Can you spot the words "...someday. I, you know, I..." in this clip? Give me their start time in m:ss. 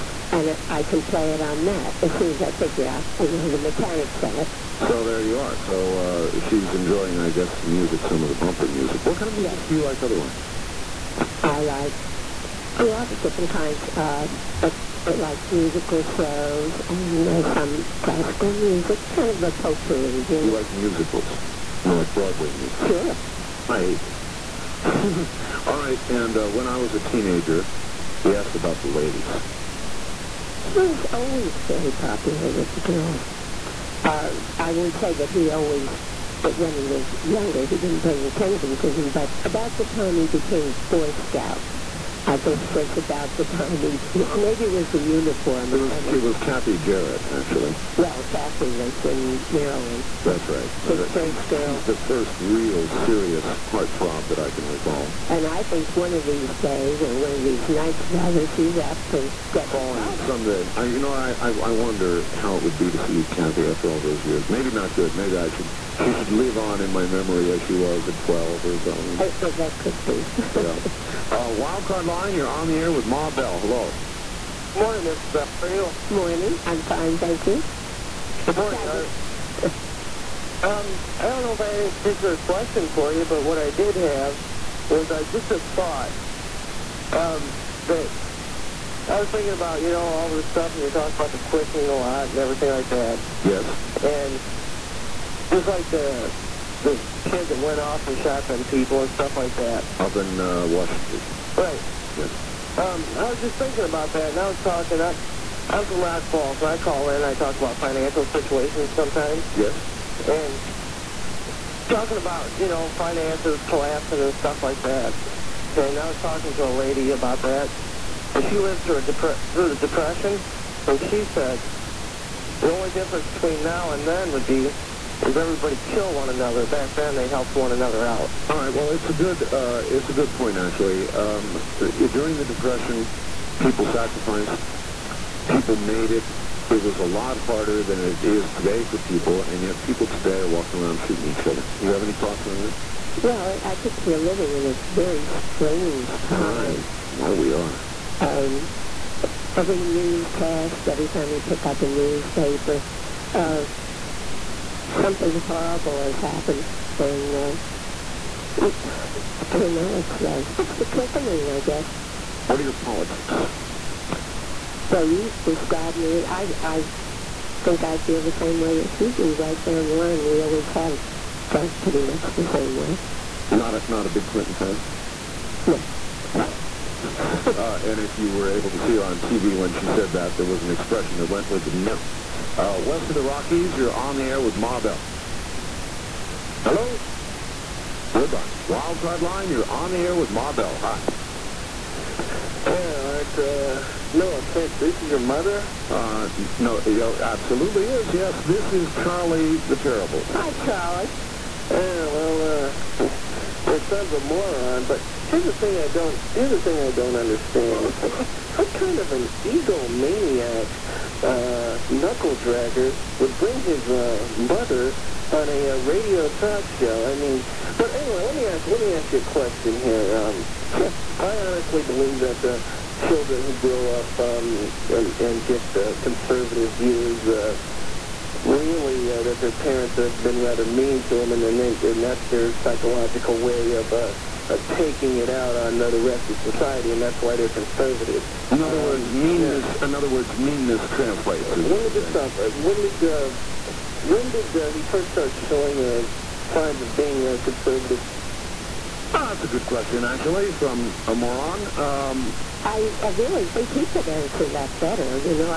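1:00.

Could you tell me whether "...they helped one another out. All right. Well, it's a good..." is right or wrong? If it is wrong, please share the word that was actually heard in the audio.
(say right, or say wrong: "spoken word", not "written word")
right.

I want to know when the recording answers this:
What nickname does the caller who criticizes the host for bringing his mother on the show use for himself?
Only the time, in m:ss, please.
3:19.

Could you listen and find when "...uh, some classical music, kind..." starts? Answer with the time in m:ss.
0:17.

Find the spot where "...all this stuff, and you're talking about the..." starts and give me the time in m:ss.
1:30.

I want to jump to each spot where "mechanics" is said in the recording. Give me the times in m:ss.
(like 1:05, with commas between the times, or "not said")
0:03.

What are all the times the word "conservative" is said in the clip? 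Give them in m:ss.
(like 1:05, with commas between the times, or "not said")
3:46, 3:57, 4:07.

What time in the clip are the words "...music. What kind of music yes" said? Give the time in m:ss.
0:08.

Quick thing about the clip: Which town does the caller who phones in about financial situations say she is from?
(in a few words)
Rock Falls.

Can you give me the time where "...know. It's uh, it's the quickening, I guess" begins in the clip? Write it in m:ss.
2:39.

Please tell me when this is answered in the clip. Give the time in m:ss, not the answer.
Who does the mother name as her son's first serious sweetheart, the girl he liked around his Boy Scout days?
0:46.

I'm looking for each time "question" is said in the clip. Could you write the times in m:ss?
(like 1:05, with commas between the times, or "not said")
1:22, 3:39, 4:09.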